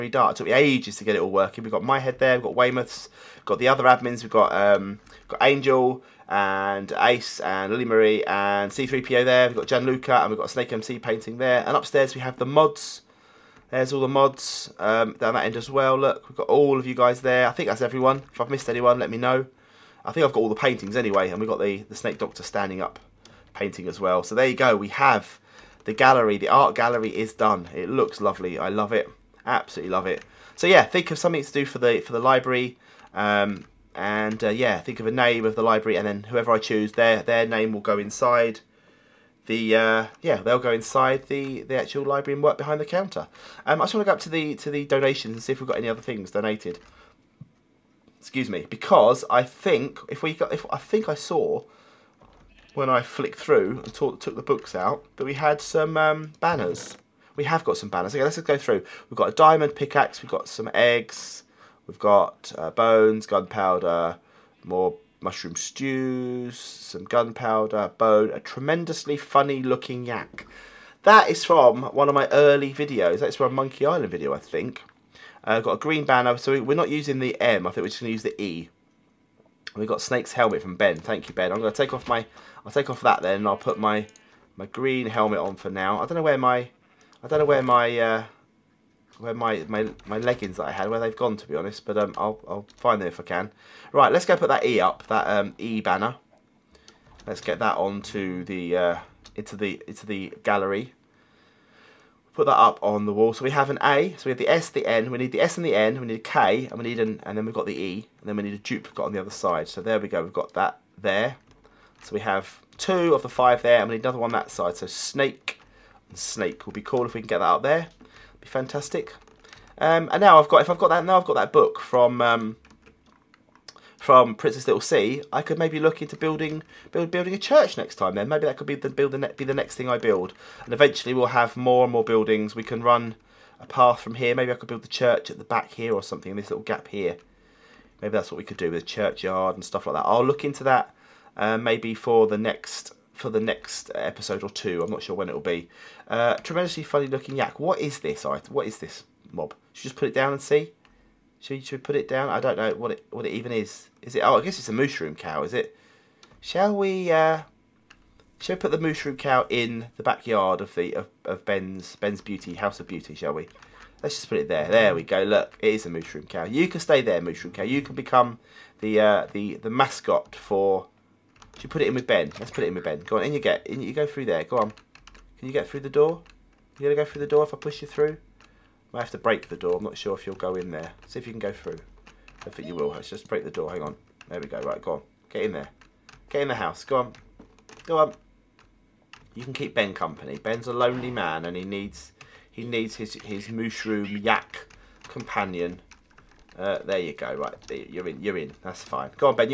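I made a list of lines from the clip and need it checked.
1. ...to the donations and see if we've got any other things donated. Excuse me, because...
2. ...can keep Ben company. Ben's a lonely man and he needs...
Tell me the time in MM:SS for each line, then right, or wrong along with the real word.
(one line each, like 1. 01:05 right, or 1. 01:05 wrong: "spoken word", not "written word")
1. 00:44 right
2. 03:09 right.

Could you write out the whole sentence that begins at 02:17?
Maybe that's what we could do with a churchyard and stuff like that.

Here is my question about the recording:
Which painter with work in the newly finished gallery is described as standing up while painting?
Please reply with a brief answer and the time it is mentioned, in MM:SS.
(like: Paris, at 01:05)
The Snake Doctor, at 00:21.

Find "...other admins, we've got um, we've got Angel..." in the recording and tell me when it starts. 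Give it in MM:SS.
00:03.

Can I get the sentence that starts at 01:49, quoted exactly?
So there we go, we've got that there.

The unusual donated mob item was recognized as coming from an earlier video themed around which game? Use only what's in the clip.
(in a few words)
Monkey Island.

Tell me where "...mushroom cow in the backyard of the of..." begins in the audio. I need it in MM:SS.
02:38.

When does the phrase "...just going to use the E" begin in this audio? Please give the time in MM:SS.
01:17.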